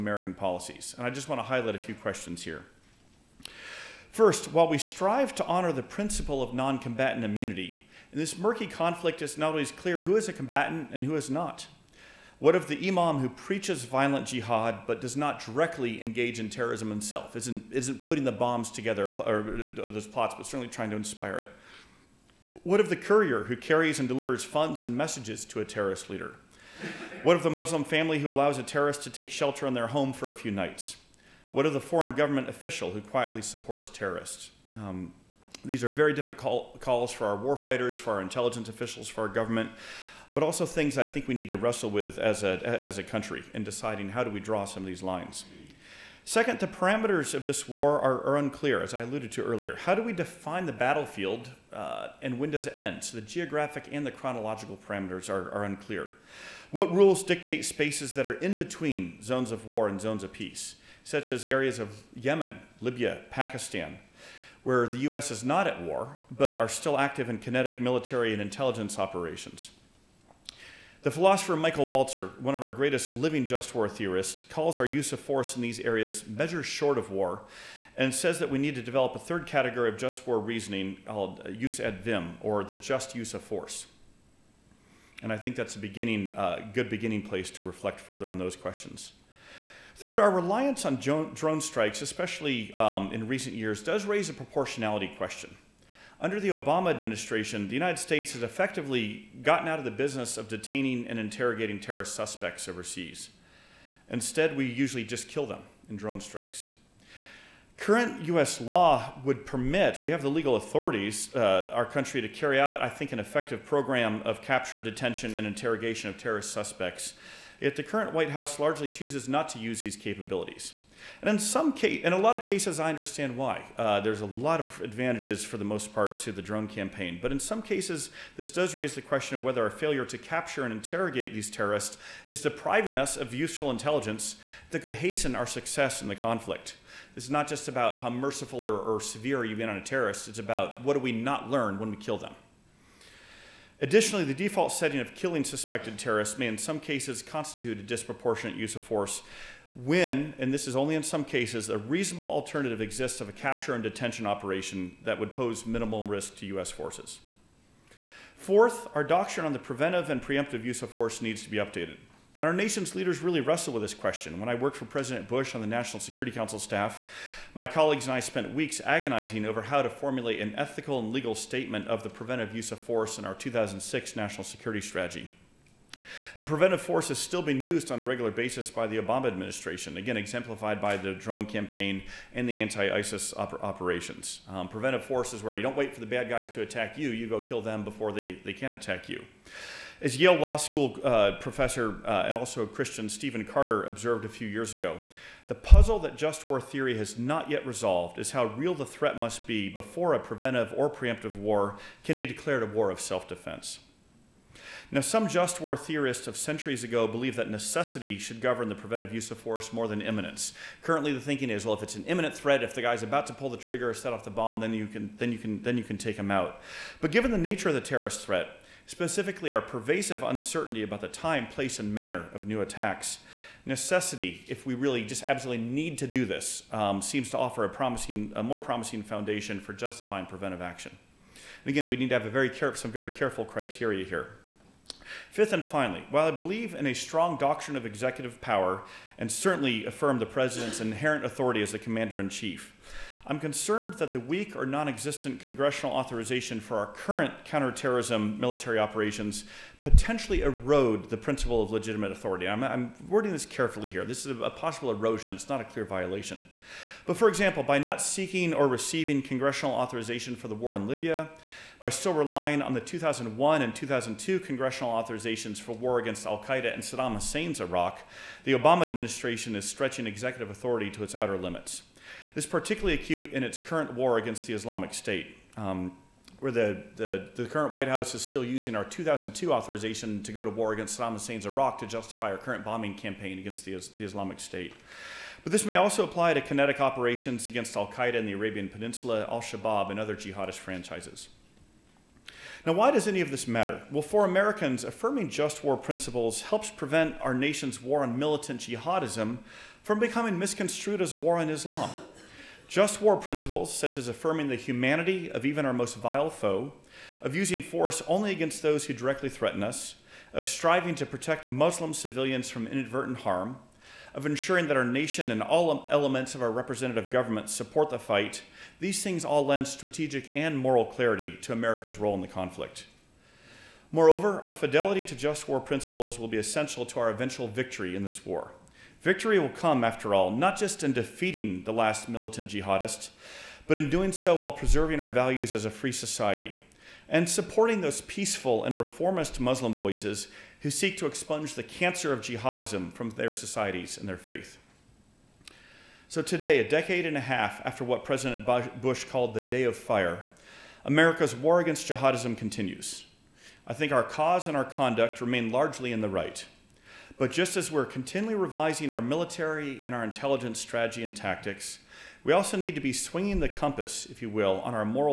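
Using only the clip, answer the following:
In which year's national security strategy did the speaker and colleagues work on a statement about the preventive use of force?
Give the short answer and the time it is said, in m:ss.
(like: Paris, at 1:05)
2006, at 2:53.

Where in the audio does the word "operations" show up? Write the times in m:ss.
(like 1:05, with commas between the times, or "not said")
1:08, 2:34, 3:03, 4:08, 4:46.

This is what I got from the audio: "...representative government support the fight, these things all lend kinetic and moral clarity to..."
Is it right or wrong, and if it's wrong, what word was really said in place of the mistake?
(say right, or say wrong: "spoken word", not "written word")
wrong: "strategic", not "kinetic".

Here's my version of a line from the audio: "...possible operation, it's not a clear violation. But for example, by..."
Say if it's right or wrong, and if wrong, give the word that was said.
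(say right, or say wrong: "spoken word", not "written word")
wrong: "erosion", not "operation".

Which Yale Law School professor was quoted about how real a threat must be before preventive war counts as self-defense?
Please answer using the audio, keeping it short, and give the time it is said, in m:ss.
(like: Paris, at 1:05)
Stephen Carter, at 3:13.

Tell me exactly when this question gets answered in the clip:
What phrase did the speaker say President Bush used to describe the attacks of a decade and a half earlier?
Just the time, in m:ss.
5:49.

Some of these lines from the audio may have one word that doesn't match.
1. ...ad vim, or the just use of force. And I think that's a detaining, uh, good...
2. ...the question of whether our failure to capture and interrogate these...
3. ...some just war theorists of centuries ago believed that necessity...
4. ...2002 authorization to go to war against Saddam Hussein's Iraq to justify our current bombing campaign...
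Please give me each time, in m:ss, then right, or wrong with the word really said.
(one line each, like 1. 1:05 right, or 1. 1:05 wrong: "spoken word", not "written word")
1. 1:21 wrong: "beginning", not "detaining"
2. 2:08 right
3. 3:25 right
4. 4:38 right.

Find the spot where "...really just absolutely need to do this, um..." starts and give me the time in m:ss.
3:44.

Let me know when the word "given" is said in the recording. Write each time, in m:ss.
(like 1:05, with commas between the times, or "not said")
3:37.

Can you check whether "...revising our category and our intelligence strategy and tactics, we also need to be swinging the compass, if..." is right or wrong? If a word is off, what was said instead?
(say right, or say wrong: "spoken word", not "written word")
wrong: "military", not "category".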